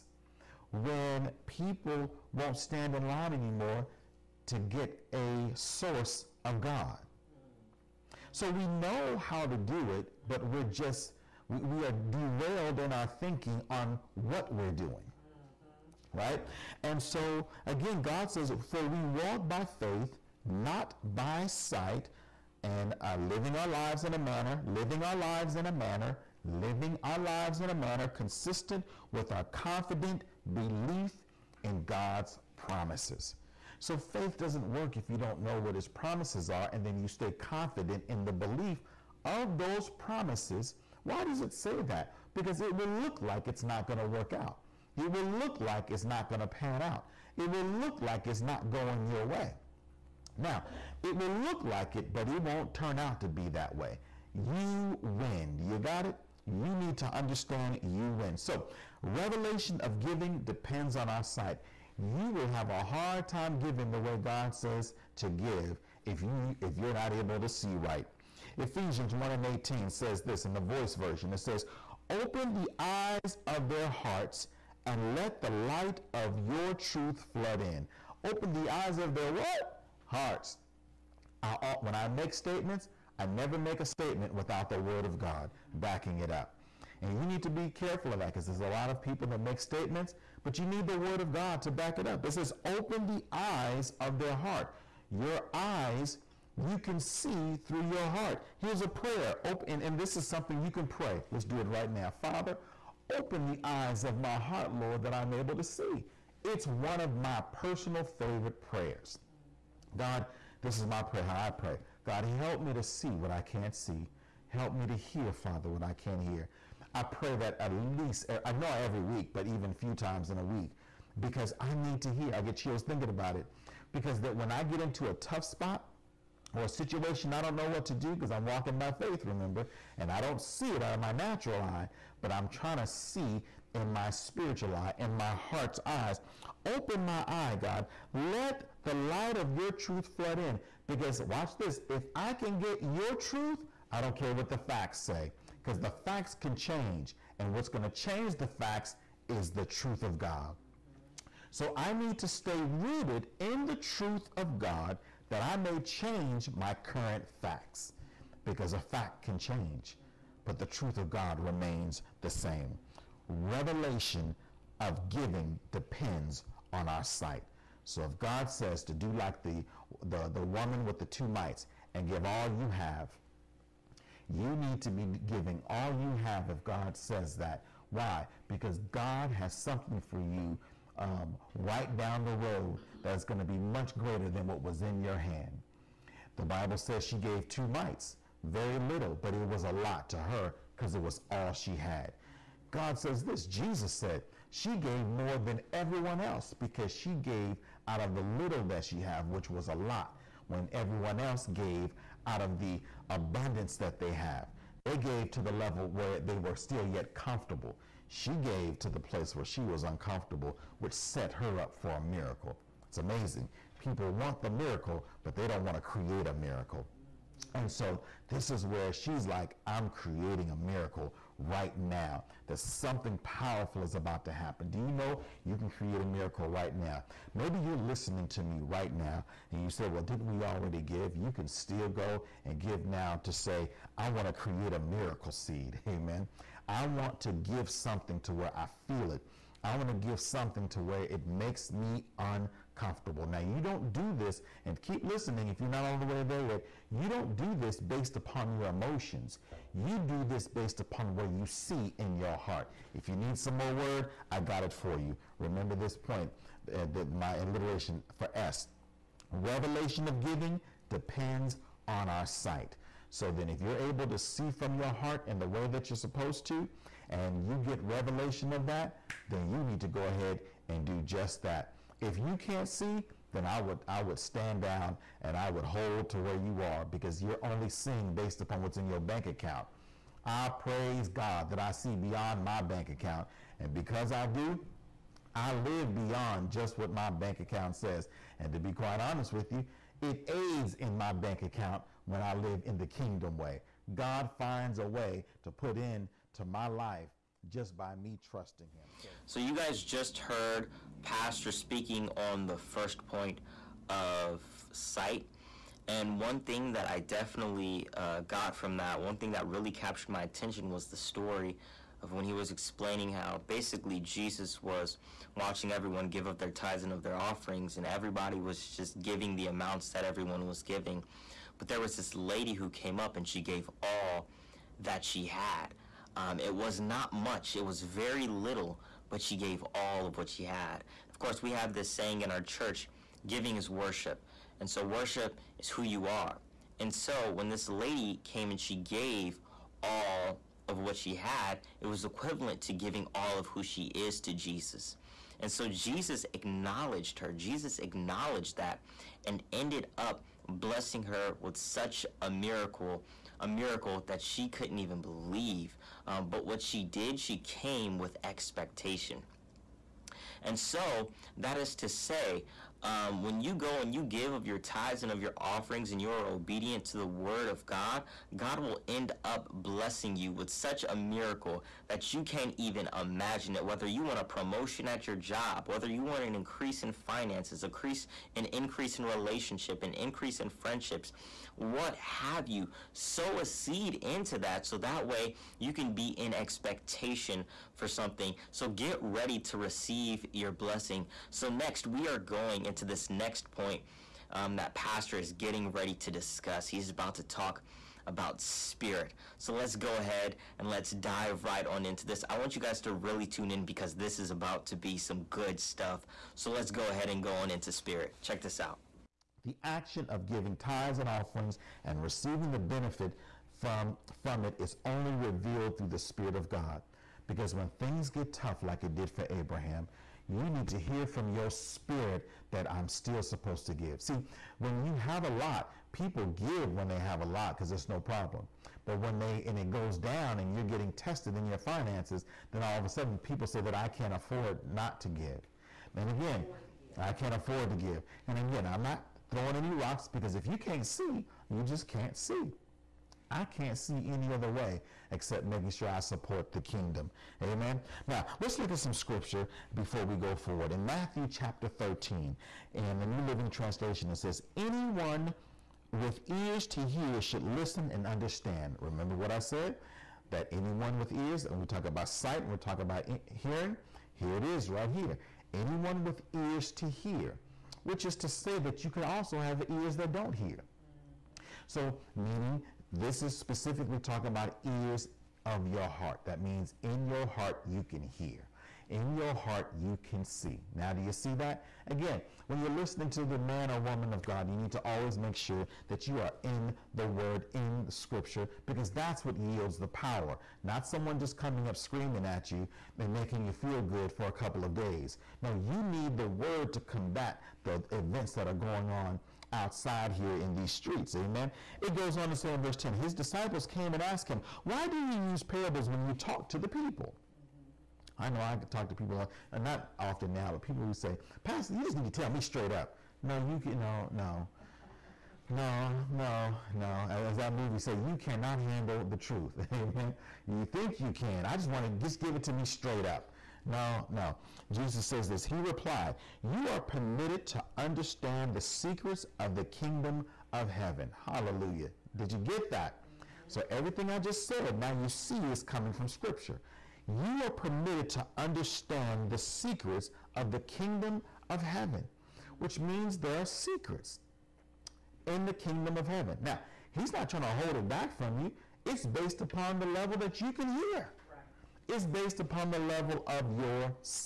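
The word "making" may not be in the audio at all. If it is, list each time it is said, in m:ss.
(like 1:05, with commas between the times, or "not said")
7:25, 8:13.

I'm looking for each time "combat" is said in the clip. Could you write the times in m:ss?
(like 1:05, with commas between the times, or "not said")
8:16.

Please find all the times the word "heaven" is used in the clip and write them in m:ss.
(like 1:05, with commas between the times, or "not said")
8:50, 9:01, 9:06.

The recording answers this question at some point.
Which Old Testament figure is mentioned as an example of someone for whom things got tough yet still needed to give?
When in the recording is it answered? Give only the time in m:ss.
6:59.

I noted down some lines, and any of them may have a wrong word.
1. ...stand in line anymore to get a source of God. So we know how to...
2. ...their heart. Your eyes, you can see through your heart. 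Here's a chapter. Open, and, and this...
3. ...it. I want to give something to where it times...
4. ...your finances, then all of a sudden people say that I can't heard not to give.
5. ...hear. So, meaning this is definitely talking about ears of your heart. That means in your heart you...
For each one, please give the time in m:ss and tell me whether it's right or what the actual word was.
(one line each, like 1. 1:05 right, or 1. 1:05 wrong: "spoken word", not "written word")
1. 0:02 right
2. 1:34 wrong: "prayer", not "chapter"
3. 3:59 wrong: "makes", not "times"
4. 7:11 wrong: "afford", not "heard"
5. 7:50 wrong: "specifically", not "definitely".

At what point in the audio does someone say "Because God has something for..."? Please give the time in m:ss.
2:58.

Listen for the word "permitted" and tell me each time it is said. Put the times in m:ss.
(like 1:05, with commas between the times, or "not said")
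8:46, 8:57.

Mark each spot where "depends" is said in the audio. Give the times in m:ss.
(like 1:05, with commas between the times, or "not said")
1:00, 2:45, 4:20.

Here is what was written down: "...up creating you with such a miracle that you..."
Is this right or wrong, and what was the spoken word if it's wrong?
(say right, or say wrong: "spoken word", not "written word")
wrong: "blessing", not "creating".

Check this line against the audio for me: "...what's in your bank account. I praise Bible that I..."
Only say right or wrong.
wrong.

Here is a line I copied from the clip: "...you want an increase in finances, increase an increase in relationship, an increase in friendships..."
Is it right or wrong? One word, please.
right.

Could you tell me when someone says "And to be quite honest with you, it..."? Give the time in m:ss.
4:48.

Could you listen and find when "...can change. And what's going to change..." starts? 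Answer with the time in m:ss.
2:26.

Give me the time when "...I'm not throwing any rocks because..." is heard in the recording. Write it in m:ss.
7:18.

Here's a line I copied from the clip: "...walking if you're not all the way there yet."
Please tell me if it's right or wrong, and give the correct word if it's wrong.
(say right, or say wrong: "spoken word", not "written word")
wrong: "listening", not "walking".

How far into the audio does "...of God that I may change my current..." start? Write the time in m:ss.
2:34.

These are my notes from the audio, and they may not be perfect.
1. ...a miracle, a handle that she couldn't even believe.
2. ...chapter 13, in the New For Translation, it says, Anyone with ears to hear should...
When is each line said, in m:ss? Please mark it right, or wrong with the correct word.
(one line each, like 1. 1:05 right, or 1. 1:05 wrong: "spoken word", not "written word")
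1. 5:52 wrong: "miracle", not "handle"
2. 7:31 wrong: "Living", not "For".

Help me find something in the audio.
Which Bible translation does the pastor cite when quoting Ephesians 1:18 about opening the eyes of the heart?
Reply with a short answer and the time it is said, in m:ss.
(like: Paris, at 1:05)
The Voice, at 1:10.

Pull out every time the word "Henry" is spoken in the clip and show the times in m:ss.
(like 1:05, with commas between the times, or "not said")
not said.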